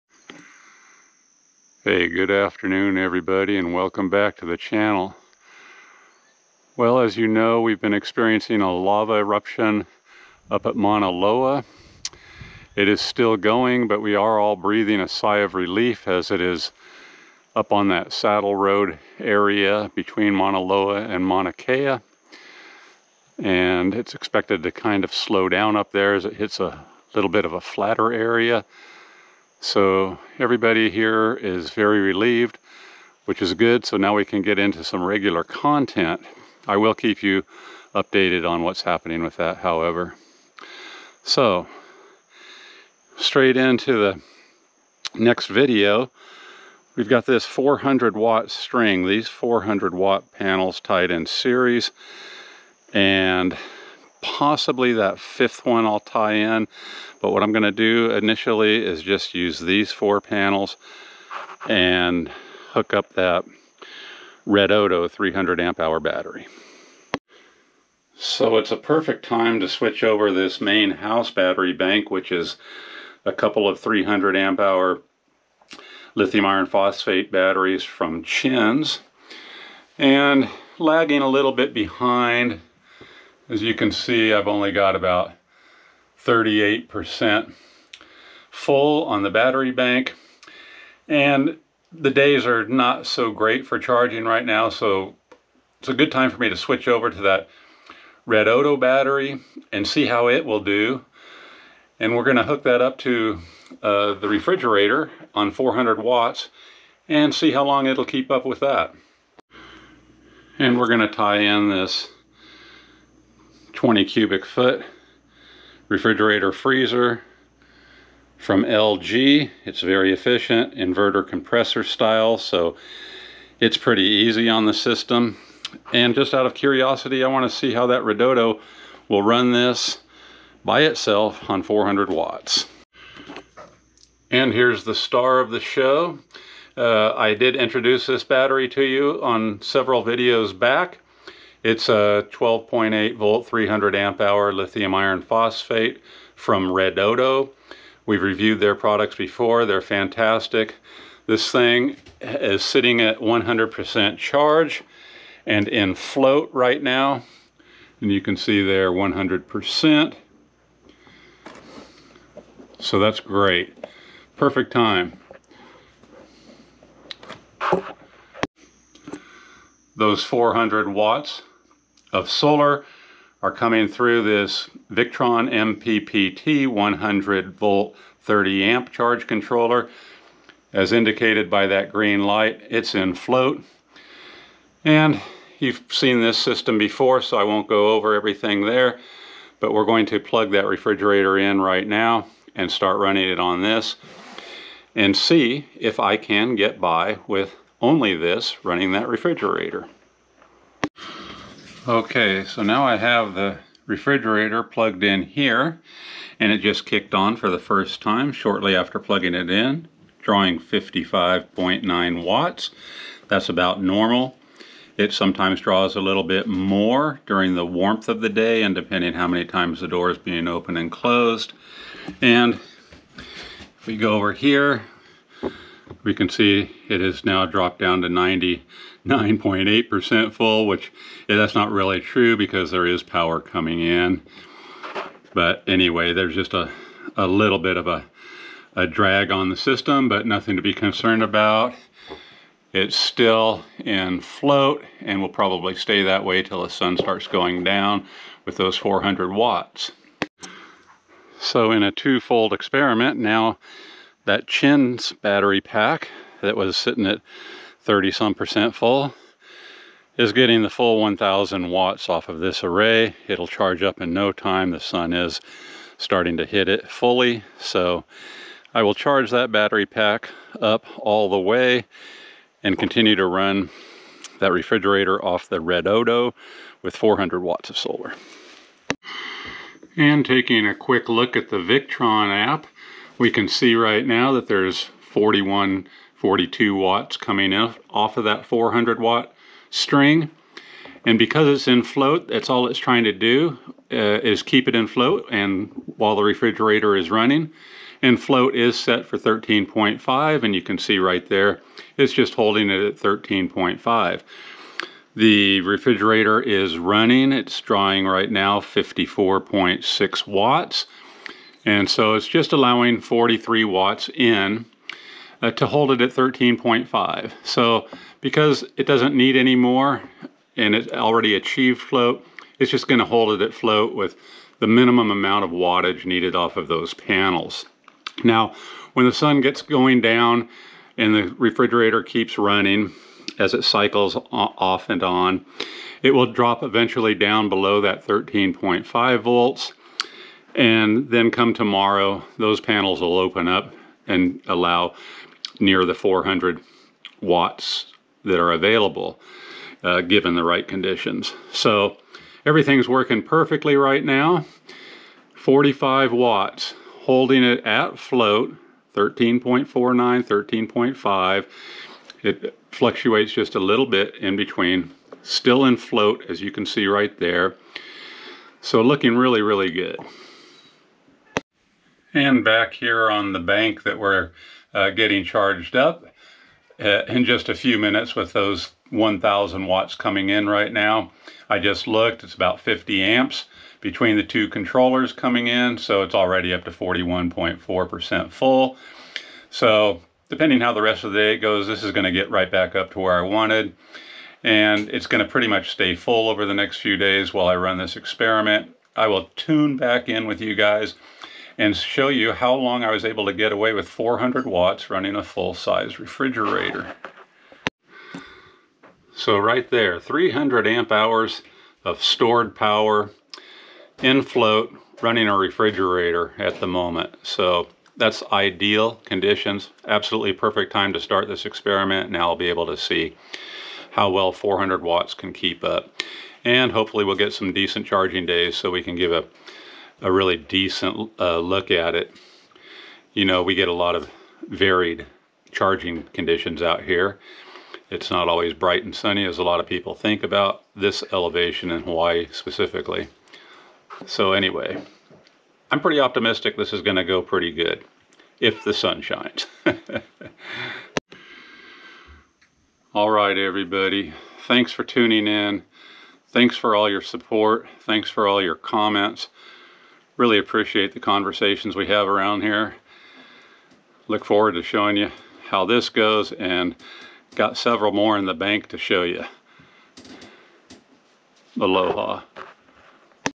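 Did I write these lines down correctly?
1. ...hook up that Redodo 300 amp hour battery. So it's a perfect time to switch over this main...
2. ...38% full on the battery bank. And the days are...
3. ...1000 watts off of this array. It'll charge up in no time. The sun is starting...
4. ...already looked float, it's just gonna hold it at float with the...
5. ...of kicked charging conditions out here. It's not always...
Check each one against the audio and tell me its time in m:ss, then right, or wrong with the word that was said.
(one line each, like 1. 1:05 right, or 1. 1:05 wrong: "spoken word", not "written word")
1. 1:02 right
2. 1:26 right
3. 4:21 right
4. 5:20 wrong: "achieved", not "looked"
5. 7:13 wrong: "varied", not "kicked".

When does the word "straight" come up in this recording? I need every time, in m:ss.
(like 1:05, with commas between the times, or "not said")
0:43.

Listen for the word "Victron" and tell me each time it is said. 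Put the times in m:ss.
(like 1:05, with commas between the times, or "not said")
2:54, 4:41.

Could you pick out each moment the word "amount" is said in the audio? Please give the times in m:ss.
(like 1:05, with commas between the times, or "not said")
5:25.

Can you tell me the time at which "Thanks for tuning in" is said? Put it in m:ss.
7:34.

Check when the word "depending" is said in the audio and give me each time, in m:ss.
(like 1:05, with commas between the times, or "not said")
3:38, 6:30.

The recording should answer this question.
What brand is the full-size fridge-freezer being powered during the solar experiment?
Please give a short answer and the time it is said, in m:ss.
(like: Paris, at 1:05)
LG, at 1:58.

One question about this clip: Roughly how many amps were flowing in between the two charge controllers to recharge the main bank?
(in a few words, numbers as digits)
50 amps.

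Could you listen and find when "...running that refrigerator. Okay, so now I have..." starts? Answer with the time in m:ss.
3:18.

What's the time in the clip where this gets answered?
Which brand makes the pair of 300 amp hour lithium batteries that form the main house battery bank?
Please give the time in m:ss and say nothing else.
1:18.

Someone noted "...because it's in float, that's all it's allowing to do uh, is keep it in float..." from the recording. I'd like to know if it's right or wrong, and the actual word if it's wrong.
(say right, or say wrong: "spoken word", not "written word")
wrong: "trying", not "allowing".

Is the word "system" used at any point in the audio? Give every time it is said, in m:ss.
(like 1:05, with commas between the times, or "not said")
2:04, 3:06, 3:59.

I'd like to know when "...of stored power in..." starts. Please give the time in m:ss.
6:51.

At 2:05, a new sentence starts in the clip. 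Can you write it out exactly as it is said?
And just out of curiosity, I want to see how that Redodo will run this by itself on 400 watts.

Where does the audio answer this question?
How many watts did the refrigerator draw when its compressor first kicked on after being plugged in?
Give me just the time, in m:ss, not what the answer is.
3:30.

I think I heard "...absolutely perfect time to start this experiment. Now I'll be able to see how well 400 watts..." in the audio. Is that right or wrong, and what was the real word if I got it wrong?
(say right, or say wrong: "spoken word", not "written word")
right.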